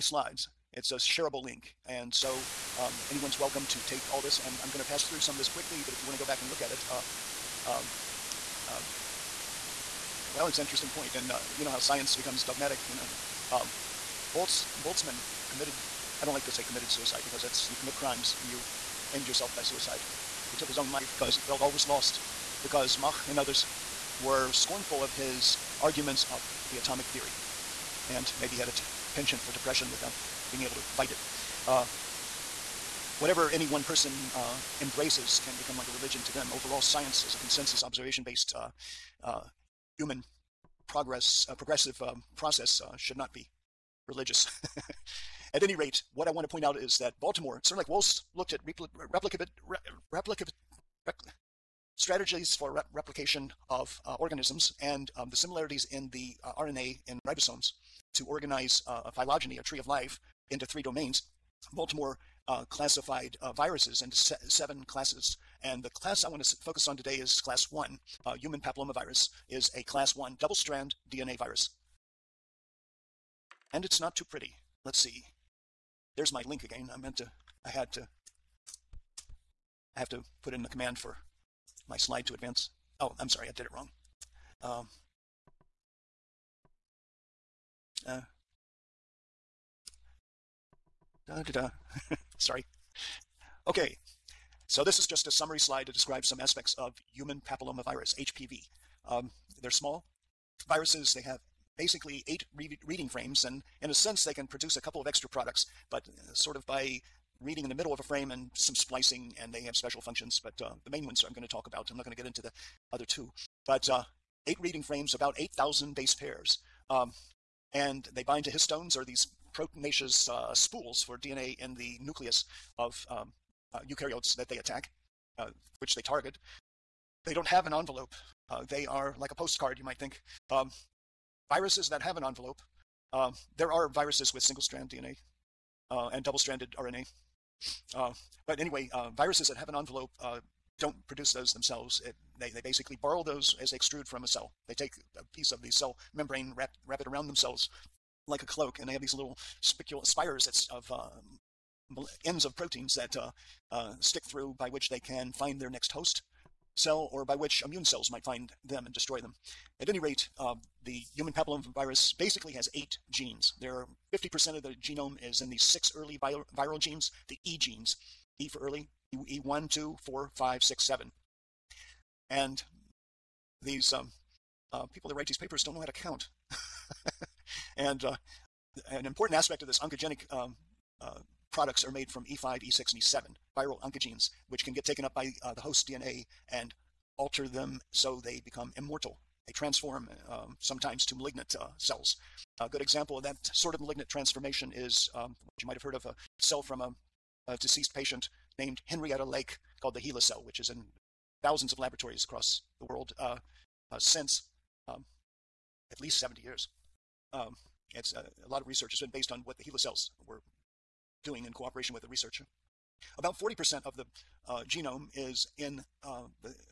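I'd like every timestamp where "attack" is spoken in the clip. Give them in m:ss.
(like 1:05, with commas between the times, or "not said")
2:04.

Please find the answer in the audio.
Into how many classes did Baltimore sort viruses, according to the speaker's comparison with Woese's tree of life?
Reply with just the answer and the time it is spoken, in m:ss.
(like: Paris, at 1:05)
7, at 1:04.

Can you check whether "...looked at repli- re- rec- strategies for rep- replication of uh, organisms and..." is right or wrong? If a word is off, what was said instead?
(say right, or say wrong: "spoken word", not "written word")
right.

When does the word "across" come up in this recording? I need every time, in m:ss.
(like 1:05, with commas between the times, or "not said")
3:22.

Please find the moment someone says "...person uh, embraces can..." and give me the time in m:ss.
0:33.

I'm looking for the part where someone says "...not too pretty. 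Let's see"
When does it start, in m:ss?
1:13.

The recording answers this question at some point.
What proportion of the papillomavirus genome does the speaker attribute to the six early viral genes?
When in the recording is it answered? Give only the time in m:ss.
2:44.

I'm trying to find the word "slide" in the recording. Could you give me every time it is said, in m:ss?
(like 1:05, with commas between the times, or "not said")
0:00, 1:21, 1:35.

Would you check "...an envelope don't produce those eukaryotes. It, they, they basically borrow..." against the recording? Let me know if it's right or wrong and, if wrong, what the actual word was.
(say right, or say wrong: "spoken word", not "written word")
wrong: "themselves", not "eukaryotes".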